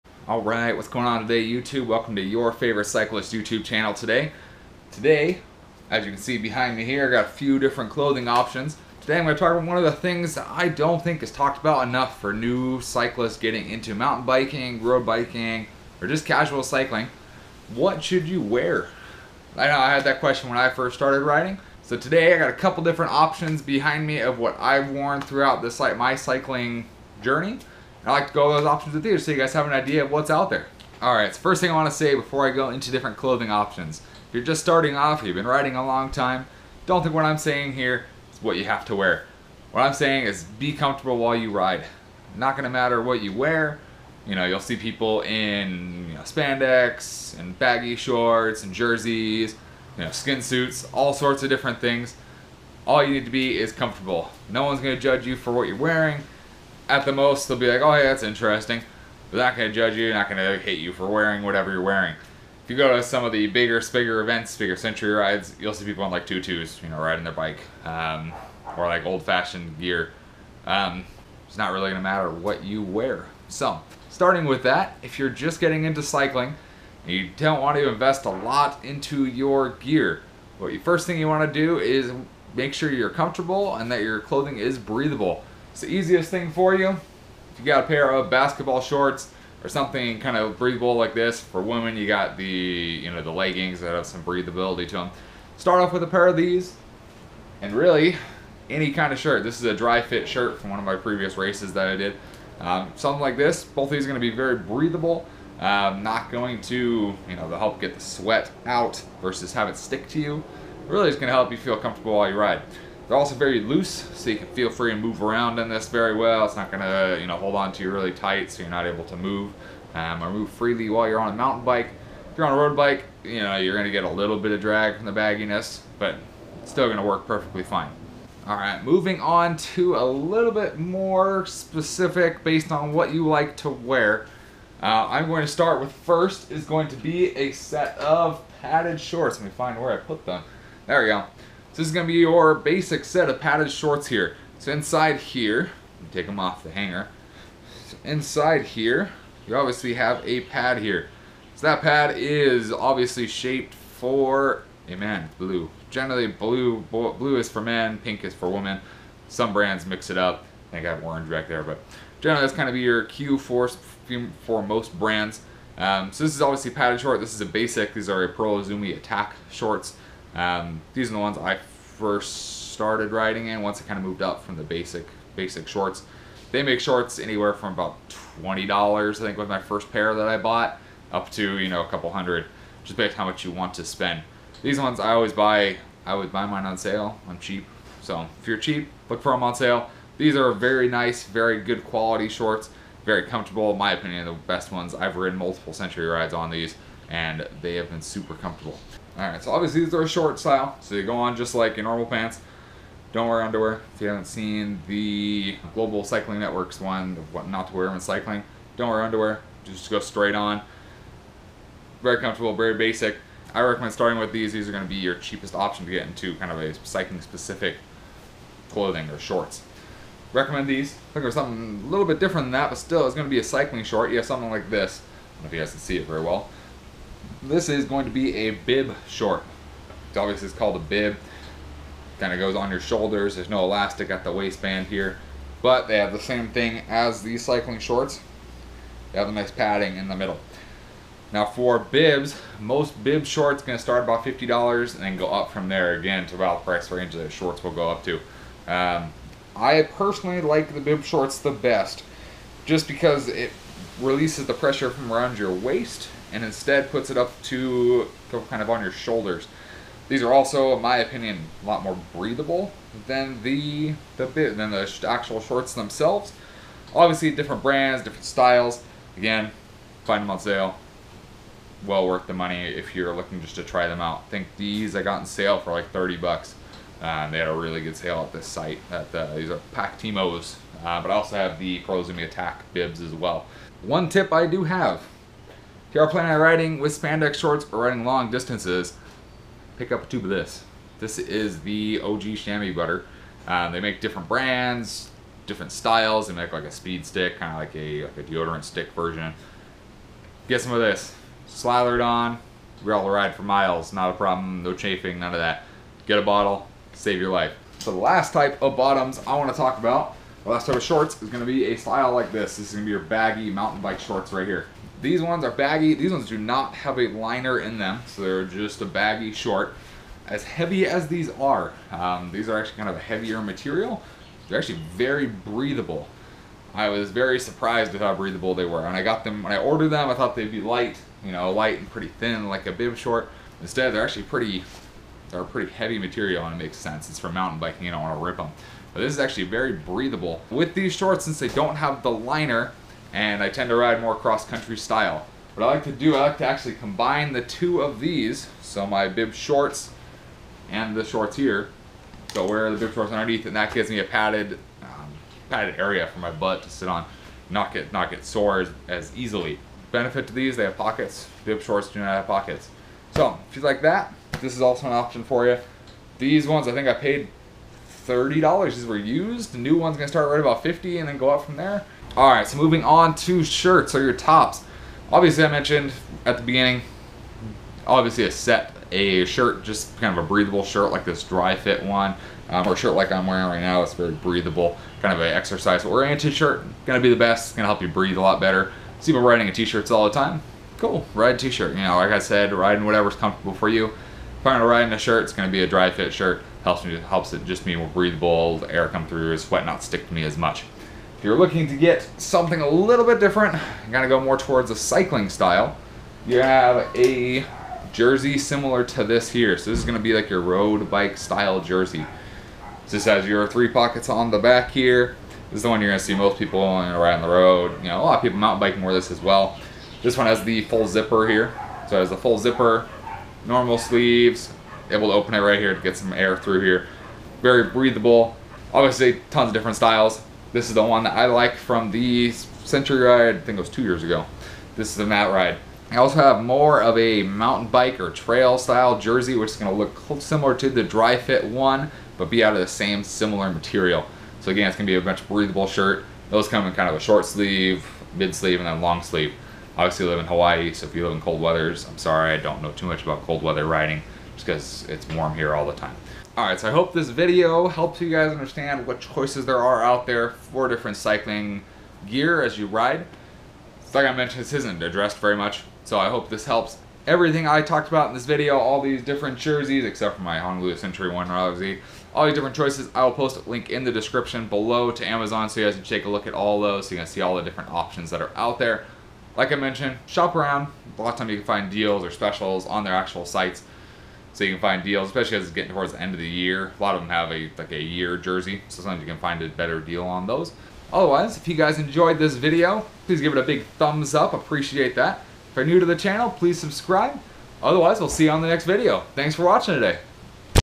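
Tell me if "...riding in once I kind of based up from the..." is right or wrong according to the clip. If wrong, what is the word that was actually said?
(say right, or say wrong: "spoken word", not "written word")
wrong: "moved", not "based".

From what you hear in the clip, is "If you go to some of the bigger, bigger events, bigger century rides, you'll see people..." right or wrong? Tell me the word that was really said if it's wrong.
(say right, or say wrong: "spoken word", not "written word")
right.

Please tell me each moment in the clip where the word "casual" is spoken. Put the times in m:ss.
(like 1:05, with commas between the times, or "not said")
0:16.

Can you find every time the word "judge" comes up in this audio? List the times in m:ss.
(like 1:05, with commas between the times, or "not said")
0:55, 0:59.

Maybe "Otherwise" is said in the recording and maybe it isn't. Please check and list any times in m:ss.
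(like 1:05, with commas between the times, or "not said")
8:10, 8:17.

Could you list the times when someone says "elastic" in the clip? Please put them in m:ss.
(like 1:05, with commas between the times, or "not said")
3:53.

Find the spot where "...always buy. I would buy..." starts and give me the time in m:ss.
3:05.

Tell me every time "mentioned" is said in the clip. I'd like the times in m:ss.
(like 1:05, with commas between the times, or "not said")
6:15, 7:44, 7:59.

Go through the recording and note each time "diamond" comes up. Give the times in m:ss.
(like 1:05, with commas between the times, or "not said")
not said.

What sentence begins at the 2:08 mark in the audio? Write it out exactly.
All right, moving on to a little bit more specific based on what you like to wear.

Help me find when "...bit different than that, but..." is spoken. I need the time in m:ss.
3:42.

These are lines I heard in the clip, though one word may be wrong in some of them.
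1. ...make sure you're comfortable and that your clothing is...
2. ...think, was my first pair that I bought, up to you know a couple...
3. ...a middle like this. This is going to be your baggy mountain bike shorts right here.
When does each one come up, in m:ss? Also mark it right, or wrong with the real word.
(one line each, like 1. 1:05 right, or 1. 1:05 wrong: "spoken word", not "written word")
1. 1:22 right
2. 2:59 right
3. 5:11 wrong: "style", not "middle".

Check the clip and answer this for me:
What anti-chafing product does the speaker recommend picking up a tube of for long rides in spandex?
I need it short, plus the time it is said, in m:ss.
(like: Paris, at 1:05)
Chamois butter, at 4:52.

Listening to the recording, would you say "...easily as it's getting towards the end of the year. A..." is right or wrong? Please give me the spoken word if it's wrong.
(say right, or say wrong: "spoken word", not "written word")
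wrong: "especially", not "easily".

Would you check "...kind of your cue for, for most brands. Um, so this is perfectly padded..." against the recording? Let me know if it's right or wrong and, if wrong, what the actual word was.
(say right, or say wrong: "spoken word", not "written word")
wrong: "obviously", not "perfectly".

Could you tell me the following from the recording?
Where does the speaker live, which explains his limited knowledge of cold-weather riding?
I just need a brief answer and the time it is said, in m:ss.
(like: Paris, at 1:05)
Hawaii, at 7:30.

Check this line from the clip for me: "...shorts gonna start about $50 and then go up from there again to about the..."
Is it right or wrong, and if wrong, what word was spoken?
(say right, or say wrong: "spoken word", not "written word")
right.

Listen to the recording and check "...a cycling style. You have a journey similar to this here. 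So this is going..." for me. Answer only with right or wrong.
wrong.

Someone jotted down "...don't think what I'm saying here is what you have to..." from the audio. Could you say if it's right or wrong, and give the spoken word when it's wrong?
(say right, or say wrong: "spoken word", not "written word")
right.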